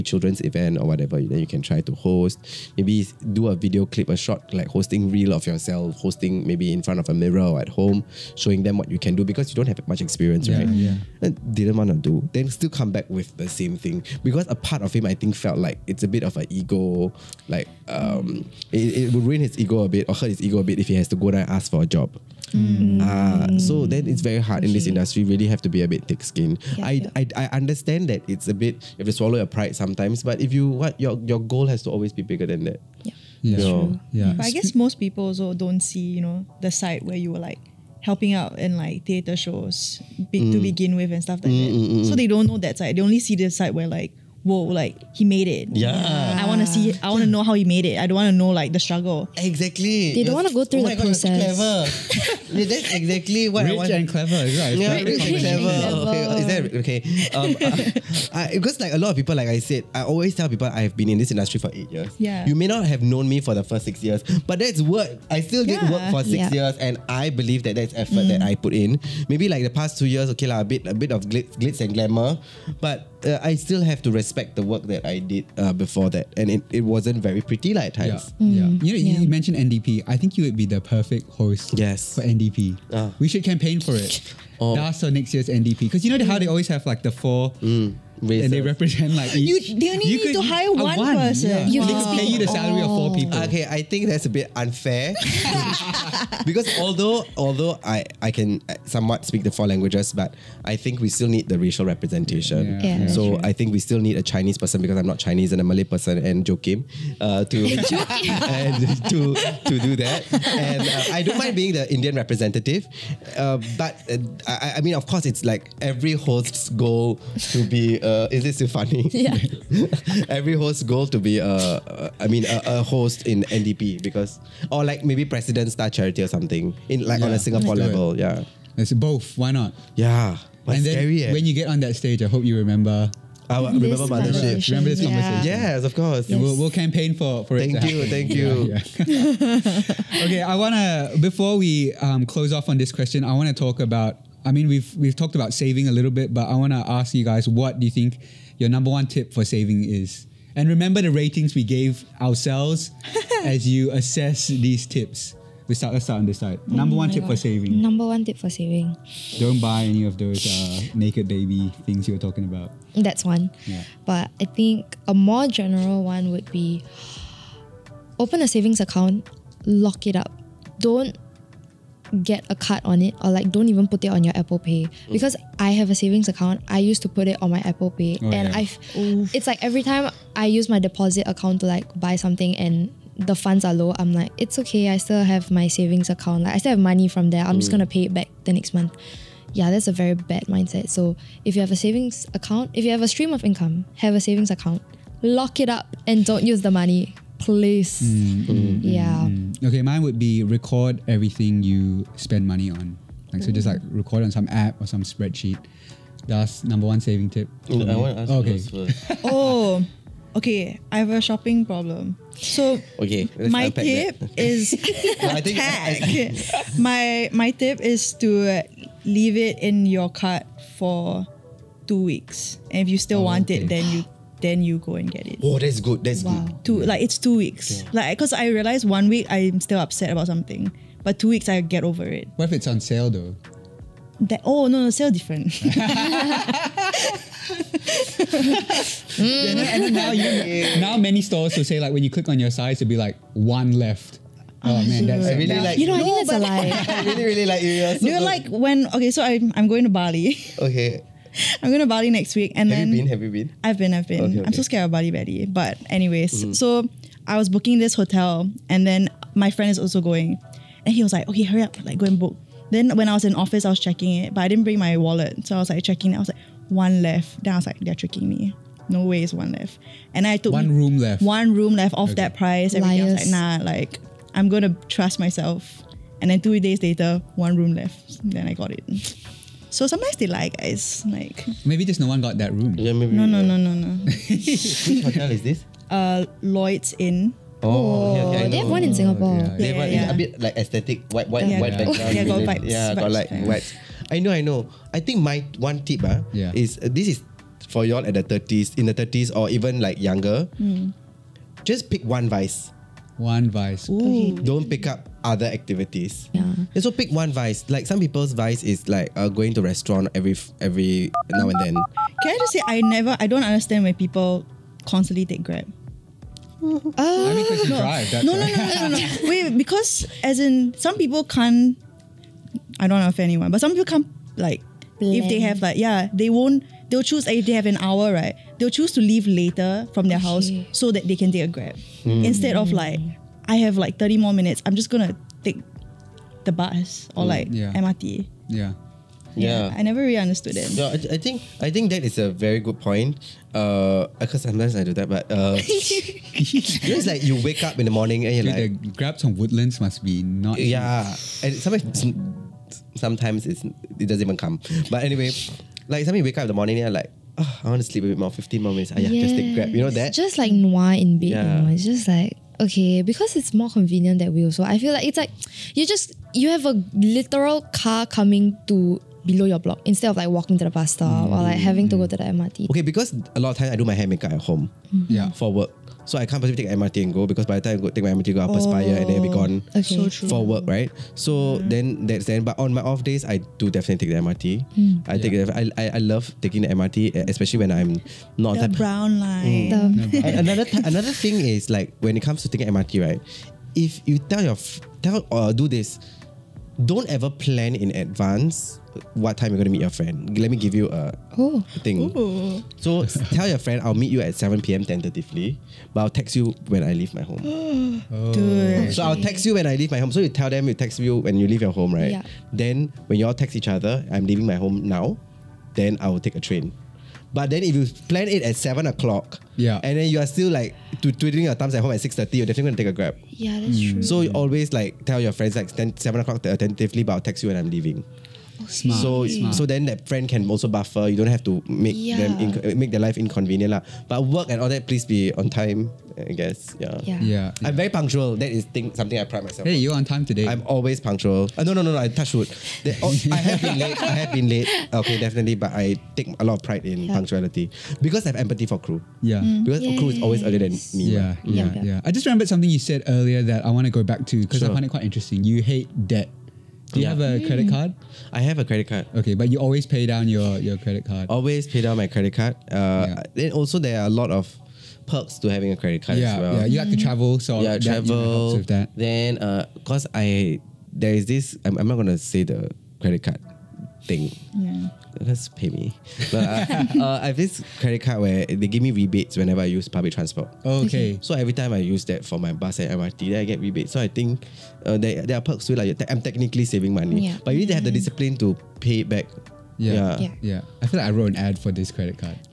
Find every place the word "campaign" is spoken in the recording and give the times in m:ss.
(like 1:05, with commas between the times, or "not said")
1:23, 2:16.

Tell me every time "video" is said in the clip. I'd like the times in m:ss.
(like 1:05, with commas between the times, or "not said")
0:03.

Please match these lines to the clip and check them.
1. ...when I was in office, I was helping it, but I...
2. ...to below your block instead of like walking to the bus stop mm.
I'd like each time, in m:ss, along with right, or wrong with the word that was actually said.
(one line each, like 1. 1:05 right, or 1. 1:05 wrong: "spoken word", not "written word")
1. 4:22 wrong: "checking", not "helping"
2. 6:08 right.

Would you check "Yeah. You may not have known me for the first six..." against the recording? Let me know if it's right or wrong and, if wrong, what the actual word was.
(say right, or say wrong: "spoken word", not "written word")
right.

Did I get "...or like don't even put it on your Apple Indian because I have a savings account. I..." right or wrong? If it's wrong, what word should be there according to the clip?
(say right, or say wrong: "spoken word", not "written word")
wrong: "Pay", not "Indian".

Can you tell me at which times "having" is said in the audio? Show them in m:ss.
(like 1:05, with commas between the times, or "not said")
6:11, 7:45.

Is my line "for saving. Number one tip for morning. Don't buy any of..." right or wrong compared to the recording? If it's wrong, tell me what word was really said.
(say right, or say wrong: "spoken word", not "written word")
wrong: "saving", not "morning".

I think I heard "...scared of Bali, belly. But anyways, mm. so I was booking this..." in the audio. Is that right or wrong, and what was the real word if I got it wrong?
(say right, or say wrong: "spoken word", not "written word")
right.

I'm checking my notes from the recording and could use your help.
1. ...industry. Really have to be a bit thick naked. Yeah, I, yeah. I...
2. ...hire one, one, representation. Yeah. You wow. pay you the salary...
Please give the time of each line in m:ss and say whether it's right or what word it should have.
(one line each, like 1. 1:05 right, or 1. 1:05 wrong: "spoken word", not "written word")
1. 0:24 wrong: "skinned", not "naked"
2. 1:30 wrong: "person", not "representation".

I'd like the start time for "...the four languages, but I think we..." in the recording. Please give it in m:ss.
1:39.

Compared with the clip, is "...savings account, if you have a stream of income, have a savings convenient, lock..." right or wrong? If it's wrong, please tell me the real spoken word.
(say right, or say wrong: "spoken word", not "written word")
wrong: "account", not "convenient".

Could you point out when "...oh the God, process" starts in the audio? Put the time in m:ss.
0:50.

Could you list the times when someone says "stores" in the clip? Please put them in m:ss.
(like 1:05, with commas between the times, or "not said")
4:01.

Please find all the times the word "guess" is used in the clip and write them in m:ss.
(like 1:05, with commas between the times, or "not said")
0:34, 7:16.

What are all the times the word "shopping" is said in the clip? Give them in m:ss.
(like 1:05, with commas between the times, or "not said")
3:31.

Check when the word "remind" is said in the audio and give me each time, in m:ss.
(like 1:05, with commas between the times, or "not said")
not said.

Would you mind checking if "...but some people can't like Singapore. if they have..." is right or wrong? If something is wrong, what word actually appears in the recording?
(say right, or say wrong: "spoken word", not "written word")
wrong: "Blend", not "Singapore".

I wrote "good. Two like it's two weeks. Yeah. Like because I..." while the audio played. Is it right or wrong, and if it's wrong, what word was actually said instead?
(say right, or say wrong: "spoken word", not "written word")
right.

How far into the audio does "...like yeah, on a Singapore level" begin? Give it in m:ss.
2:07.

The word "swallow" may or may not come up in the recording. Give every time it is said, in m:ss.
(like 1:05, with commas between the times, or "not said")
0:29.